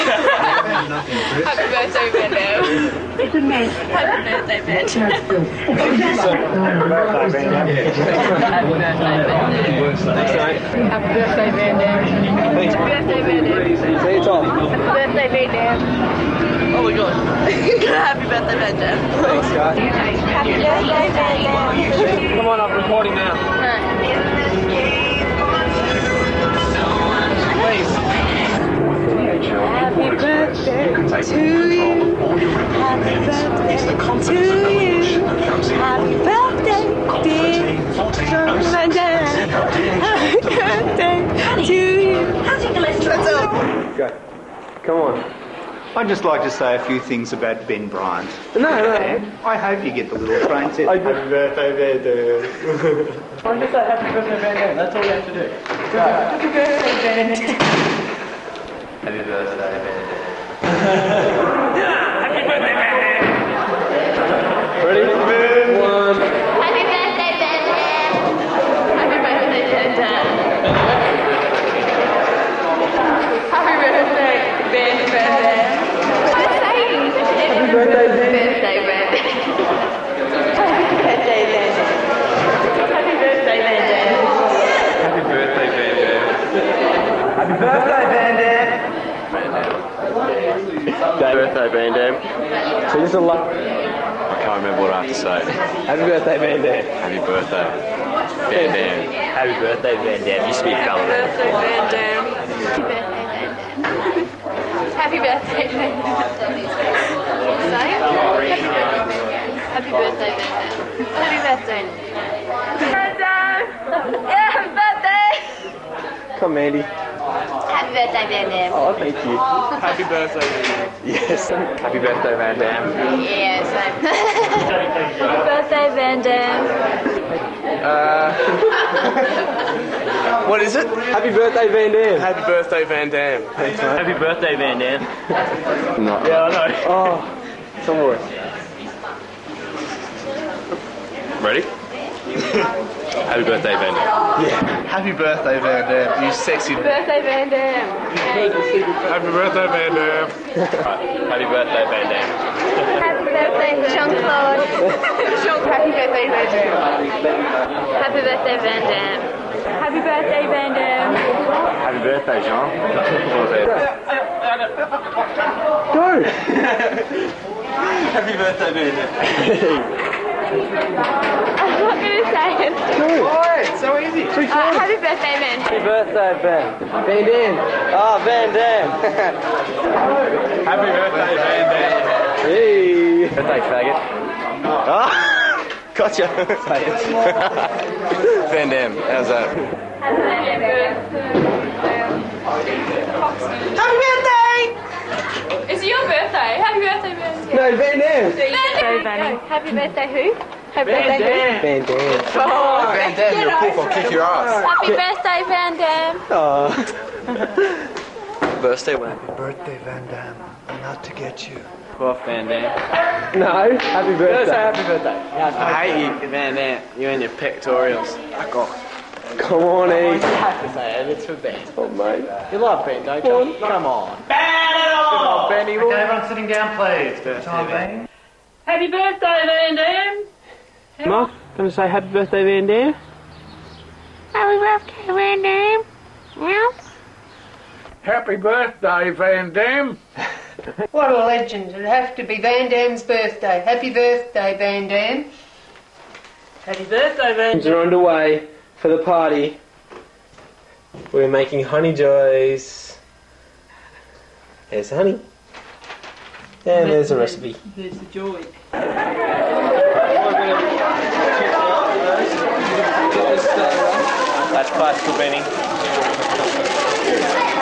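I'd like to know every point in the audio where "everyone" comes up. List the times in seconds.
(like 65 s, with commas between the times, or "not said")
225 s.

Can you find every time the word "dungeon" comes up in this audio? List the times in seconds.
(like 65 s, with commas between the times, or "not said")
not said.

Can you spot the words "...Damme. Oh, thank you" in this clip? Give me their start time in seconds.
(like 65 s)
118 s.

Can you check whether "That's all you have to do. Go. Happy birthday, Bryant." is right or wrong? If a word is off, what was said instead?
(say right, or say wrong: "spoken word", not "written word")
wrong: "Ben", not "Bryant".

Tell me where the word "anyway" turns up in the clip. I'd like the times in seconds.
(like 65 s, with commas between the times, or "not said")
not said.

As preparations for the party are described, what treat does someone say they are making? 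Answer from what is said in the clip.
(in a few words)
honey joys.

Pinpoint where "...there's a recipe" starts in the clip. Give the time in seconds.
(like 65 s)
256 s.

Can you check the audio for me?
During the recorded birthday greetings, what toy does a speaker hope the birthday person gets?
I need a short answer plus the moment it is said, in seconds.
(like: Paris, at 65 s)
little train set, at 50 s.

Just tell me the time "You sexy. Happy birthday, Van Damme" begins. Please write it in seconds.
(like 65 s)
146 s.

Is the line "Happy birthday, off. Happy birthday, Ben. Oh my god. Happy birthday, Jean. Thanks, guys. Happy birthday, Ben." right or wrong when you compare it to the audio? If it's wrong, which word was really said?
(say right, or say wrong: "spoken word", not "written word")
wrong: "Ben", not "Jean".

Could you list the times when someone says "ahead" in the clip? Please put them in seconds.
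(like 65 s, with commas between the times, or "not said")
not said.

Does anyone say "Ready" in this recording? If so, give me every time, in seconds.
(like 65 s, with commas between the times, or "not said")
64 s, 141 s.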